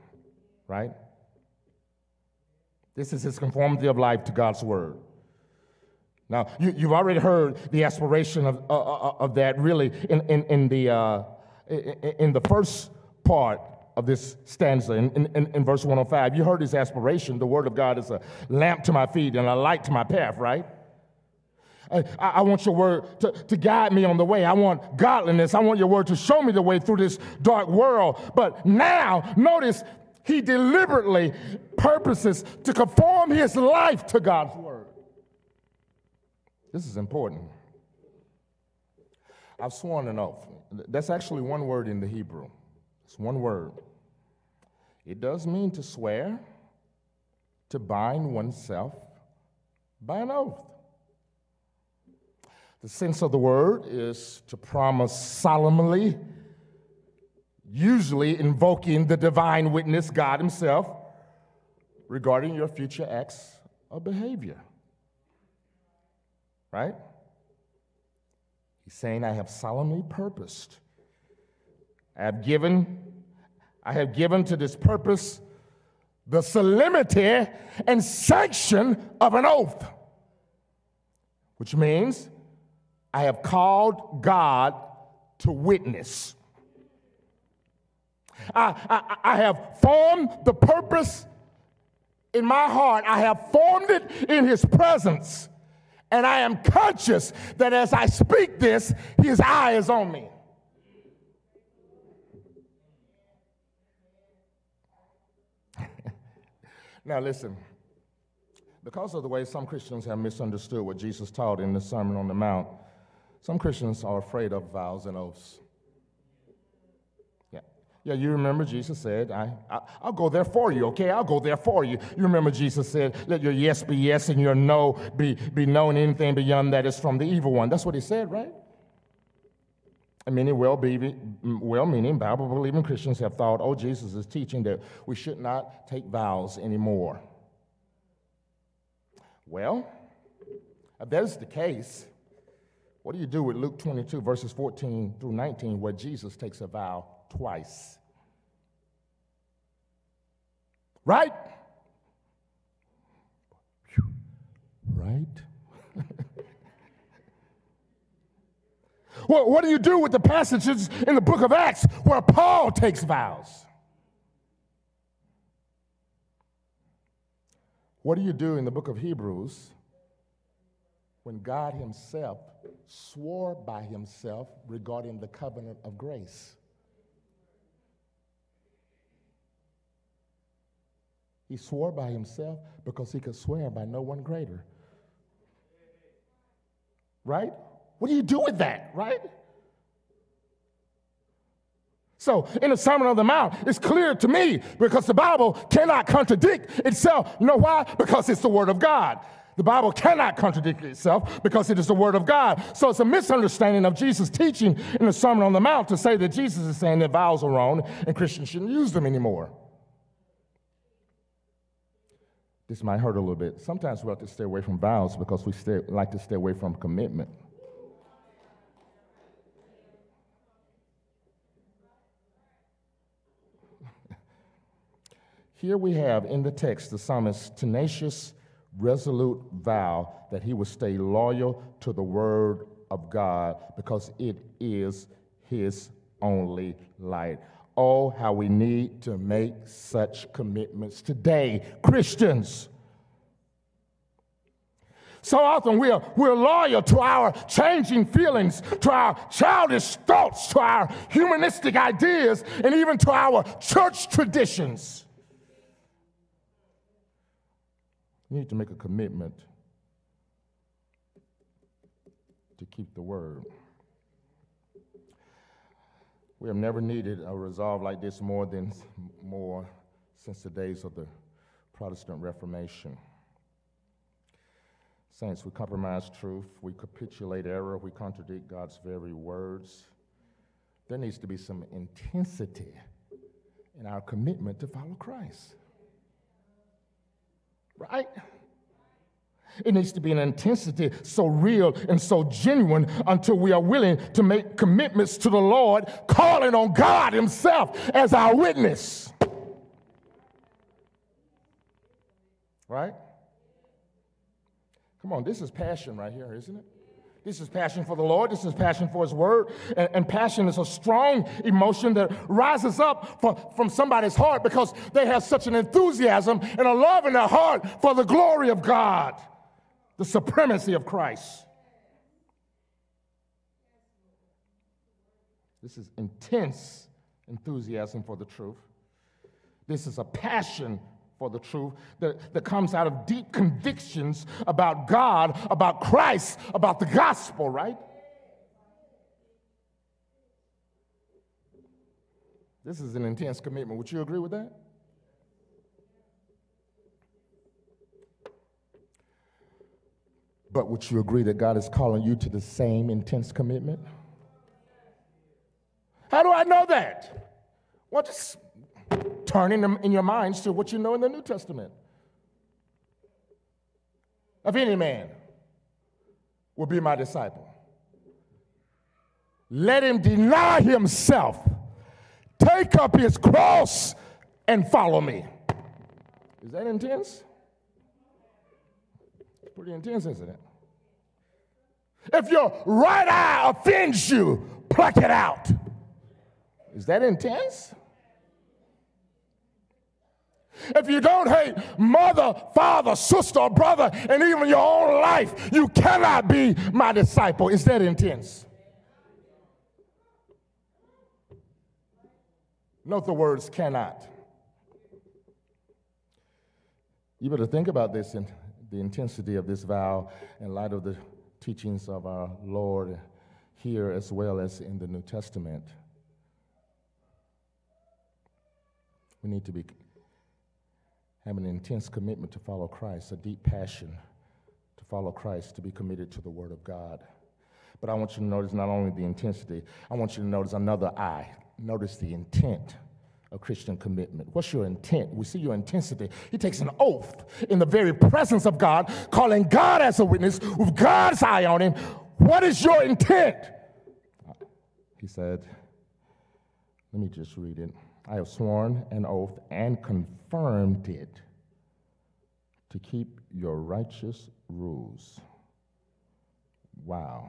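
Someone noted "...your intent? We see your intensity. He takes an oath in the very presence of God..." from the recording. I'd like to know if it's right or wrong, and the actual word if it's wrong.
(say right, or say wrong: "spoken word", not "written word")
right.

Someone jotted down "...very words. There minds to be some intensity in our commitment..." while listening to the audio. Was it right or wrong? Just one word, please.
wrong.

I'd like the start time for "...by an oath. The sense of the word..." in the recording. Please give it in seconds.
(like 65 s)
50 s.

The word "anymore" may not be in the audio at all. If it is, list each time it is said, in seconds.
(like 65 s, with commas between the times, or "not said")
136 s, 209 s.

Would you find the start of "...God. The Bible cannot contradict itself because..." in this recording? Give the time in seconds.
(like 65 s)
198 s.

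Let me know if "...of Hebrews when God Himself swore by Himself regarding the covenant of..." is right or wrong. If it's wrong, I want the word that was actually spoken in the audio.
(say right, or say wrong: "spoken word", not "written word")
right.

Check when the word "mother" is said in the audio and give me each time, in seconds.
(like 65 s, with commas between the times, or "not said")
391 s.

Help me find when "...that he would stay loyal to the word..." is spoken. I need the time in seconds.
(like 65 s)
230 s.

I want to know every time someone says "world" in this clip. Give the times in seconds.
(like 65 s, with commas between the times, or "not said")
27 s.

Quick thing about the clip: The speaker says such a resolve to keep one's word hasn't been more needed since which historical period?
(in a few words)
the Protestant Reformation.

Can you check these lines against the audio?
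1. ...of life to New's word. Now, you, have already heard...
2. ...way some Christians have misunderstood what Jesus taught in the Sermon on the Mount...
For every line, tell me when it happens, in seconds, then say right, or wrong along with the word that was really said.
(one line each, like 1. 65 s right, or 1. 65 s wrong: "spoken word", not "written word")
1. 3 s wrong: "God", not "New"
2. 109 s right.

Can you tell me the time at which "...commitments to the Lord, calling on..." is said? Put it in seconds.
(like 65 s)
294 s.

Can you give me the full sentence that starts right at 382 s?
If your right eye offends you, pluck it out.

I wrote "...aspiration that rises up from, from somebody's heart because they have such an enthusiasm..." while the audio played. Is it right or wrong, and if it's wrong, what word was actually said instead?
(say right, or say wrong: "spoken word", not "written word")
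wrong: "emotion", not "aspiration".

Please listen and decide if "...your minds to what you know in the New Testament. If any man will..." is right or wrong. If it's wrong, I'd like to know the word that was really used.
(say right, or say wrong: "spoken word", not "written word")
right.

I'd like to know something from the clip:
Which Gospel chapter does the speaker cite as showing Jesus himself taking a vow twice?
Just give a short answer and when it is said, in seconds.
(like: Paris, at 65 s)
Luke 22, at 143 s.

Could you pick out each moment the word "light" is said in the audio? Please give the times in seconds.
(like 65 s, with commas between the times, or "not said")
19 s, 236 s, 410 s.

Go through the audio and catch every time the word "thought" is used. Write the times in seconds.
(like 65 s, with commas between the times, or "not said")
133 s, 250 s.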